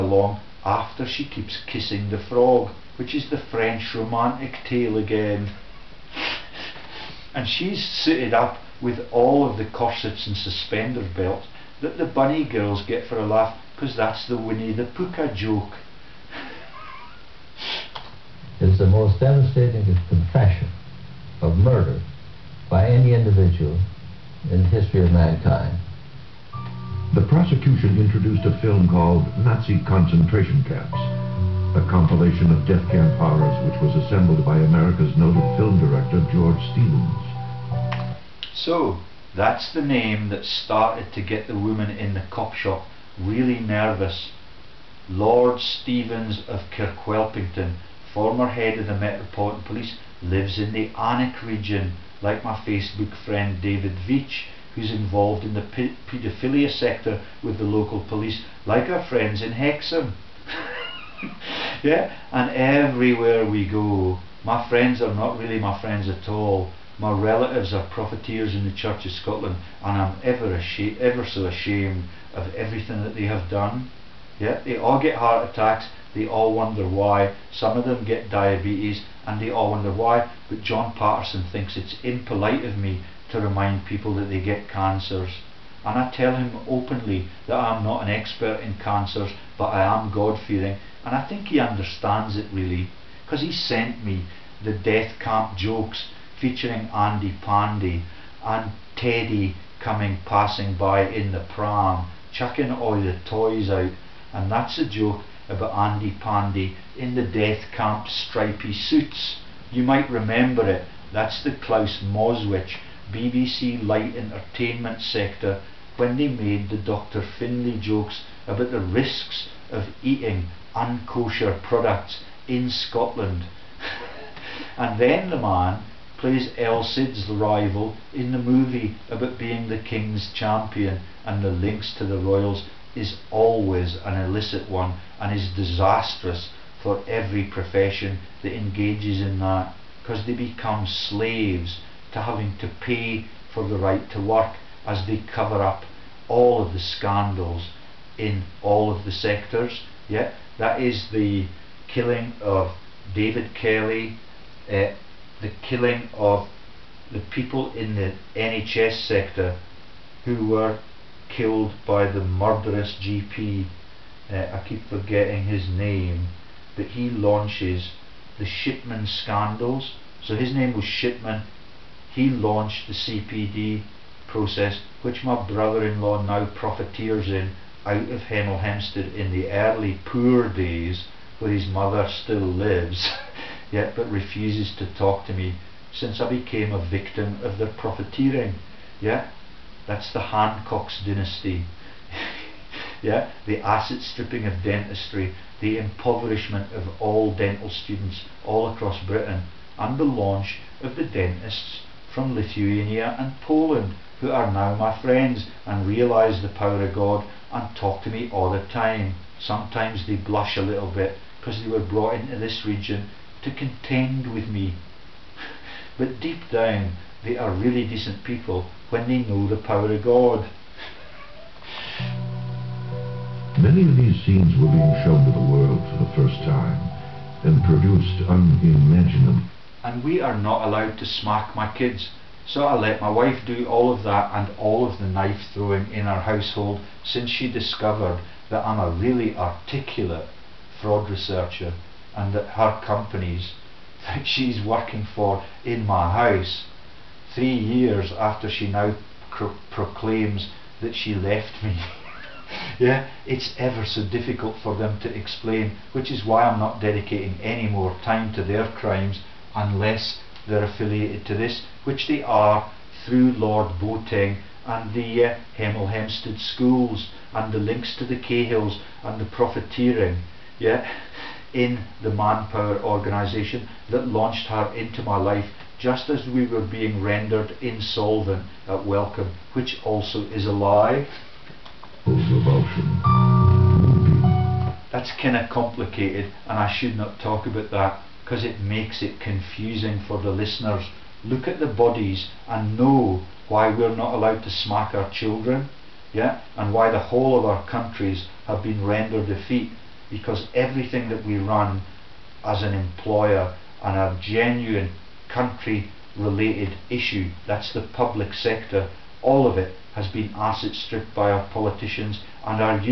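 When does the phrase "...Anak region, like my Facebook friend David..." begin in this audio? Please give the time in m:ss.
0:50.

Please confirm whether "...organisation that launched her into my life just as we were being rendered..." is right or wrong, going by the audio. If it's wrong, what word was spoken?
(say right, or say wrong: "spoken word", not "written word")
right.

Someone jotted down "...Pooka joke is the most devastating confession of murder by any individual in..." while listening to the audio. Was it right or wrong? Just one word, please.
right.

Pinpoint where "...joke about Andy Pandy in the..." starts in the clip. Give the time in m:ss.
1:44.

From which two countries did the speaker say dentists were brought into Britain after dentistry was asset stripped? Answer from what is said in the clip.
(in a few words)
Lithuania and Poland.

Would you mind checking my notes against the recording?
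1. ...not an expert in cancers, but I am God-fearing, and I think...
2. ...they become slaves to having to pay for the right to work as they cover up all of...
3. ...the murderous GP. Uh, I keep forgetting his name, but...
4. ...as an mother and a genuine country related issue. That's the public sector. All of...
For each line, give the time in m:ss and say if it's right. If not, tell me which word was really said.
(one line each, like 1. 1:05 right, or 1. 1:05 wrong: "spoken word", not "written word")
1. 1:27 right
2. 2:20 right
3. 2:42 right
4. 5:02 wrong: "employer", not "mother".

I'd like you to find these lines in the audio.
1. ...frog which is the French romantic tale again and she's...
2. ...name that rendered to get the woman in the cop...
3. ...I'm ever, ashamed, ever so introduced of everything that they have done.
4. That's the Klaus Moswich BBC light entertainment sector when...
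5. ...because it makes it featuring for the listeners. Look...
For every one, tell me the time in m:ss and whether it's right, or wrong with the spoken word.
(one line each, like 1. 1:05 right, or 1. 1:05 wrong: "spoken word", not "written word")
1. 0:02 right
2. 0:39 wrong: "started", not "rendered"
3. 1:10 wrong: "ashamed", not "introduced"
4. 1:51 right
5. 4:48 wrong: "confusing", not "featuring".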